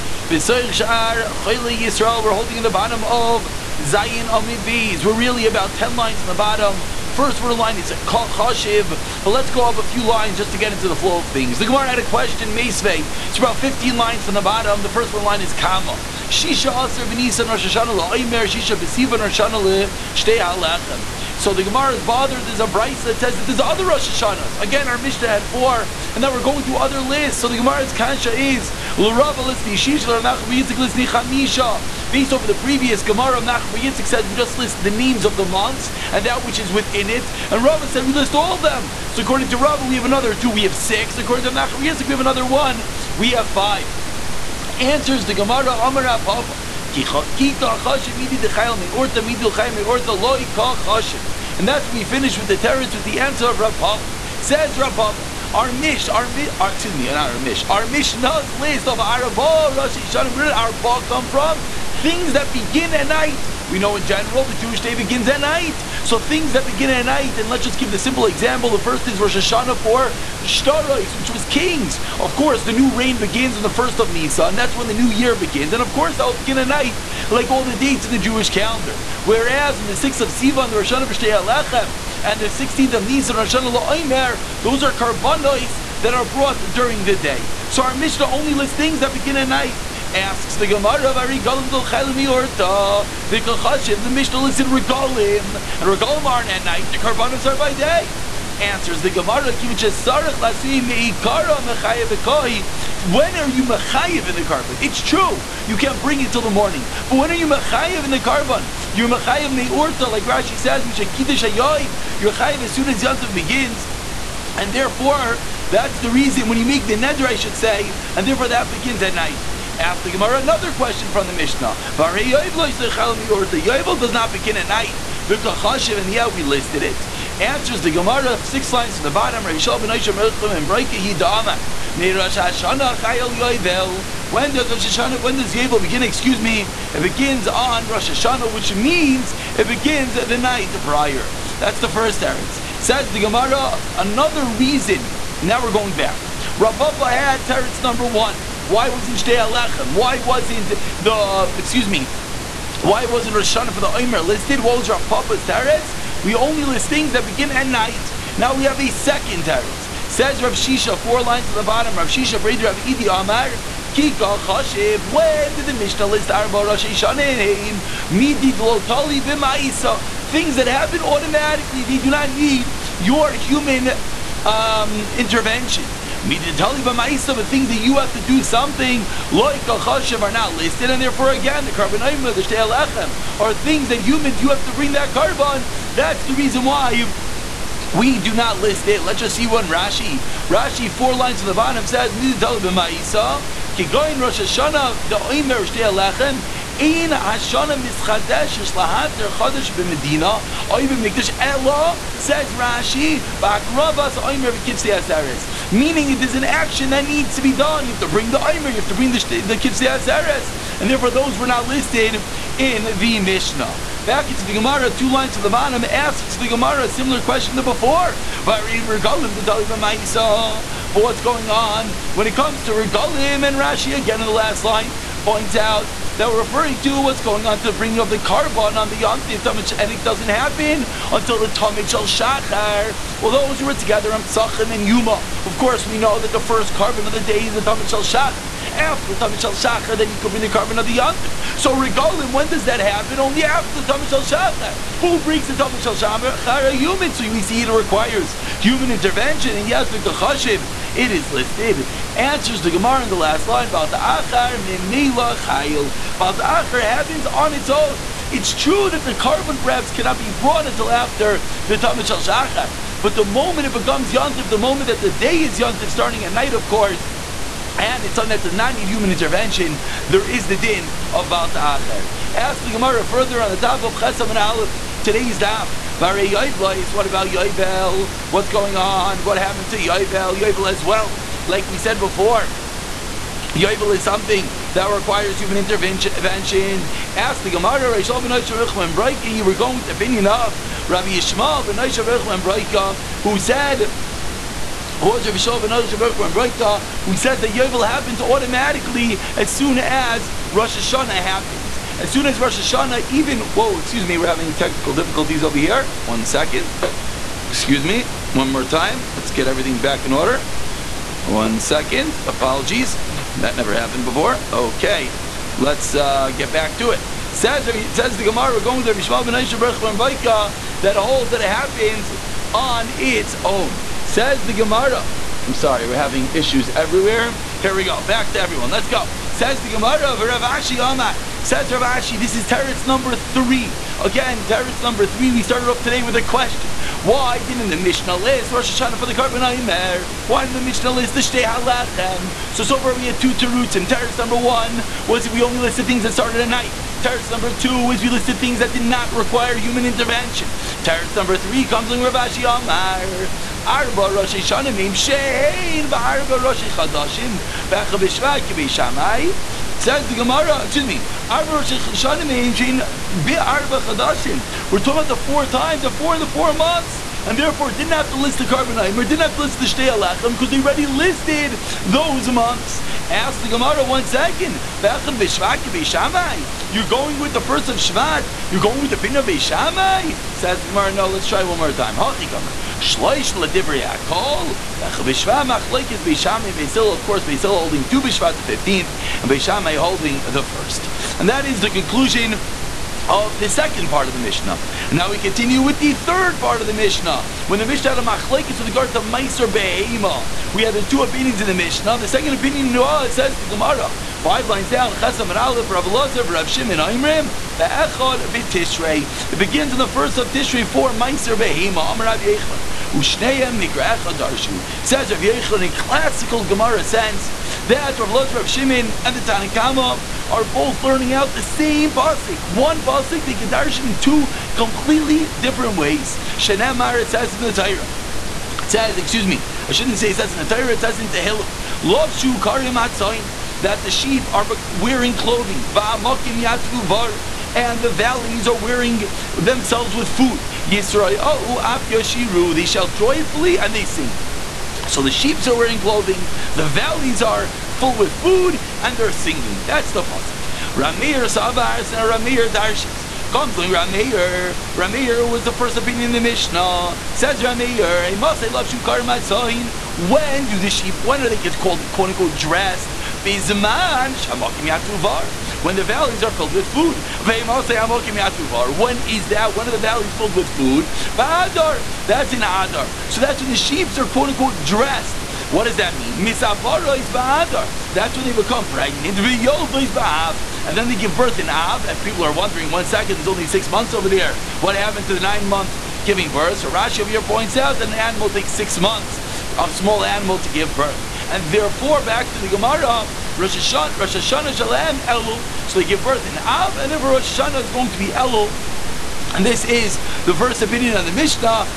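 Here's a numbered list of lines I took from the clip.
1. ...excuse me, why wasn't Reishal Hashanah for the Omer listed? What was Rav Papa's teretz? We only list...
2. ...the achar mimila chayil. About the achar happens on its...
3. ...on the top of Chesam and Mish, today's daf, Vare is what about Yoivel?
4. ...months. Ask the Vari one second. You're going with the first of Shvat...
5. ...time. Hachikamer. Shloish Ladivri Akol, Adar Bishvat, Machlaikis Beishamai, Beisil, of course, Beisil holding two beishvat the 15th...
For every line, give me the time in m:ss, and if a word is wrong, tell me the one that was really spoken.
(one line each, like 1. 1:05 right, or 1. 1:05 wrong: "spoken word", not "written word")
1. 2:31 wrong: "Rosh", not "Reishal"
2. 4:13 right
3. 4:33 wrong: "Aleph", not "Mish"
4. 6:12 wrong: "Gemara", not "Vari"
5. 6:21 wrong: "Bechel", not "Adar".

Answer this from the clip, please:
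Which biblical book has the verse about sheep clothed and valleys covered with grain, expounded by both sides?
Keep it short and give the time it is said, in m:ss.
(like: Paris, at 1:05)
Tehillim, at 7:11.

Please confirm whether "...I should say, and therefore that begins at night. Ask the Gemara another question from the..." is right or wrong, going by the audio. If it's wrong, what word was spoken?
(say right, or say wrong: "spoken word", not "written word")
right.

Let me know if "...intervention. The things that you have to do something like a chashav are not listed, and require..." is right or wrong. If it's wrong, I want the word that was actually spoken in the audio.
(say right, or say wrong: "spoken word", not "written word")
wrong: "therefore", not "require".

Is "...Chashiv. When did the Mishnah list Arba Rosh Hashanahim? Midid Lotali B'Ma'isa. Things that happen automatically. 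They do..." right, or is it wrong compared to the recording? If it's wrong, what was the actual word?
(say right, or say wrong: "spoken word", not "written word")
right.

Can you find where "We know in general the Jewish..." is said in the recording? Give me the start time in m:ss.
1:03.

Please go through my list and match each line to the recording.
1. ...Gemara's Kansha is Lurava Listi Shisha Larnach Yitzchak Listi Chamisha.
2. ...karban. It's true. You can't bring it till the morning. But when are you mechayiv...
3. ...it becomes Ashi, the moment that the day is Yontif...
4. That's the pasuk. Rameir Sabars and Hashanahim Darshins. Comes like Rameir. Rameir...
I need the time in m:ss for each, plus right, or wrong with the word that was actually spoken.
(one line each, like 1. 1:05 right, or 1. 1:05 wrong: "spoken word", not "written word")
1. 0:27 right
2. 1:44 right
3. 4:23 wrong: "Yontif", not "Ashi"
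4. 7:29 wrong: "Rameir", not "Hashanahim".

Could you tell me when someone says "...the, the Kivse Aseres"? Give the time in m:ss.
3:29.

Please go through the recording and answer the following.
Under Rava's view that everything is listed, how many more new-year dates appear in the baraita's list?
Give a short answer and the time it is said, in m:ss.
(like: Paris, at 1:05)
6, at 0:40.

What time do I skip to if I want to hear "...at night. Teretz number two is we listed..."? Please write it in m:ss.
5:46.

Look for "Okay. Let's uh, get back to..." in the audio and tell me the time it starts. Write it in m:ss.
5:14.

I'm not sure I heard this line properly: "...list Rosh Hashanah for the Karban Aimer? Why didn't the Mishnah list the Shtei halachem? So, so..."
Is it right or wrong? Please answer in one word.
right.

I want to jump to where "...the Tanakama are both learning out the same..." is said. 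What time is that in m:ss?
6:59.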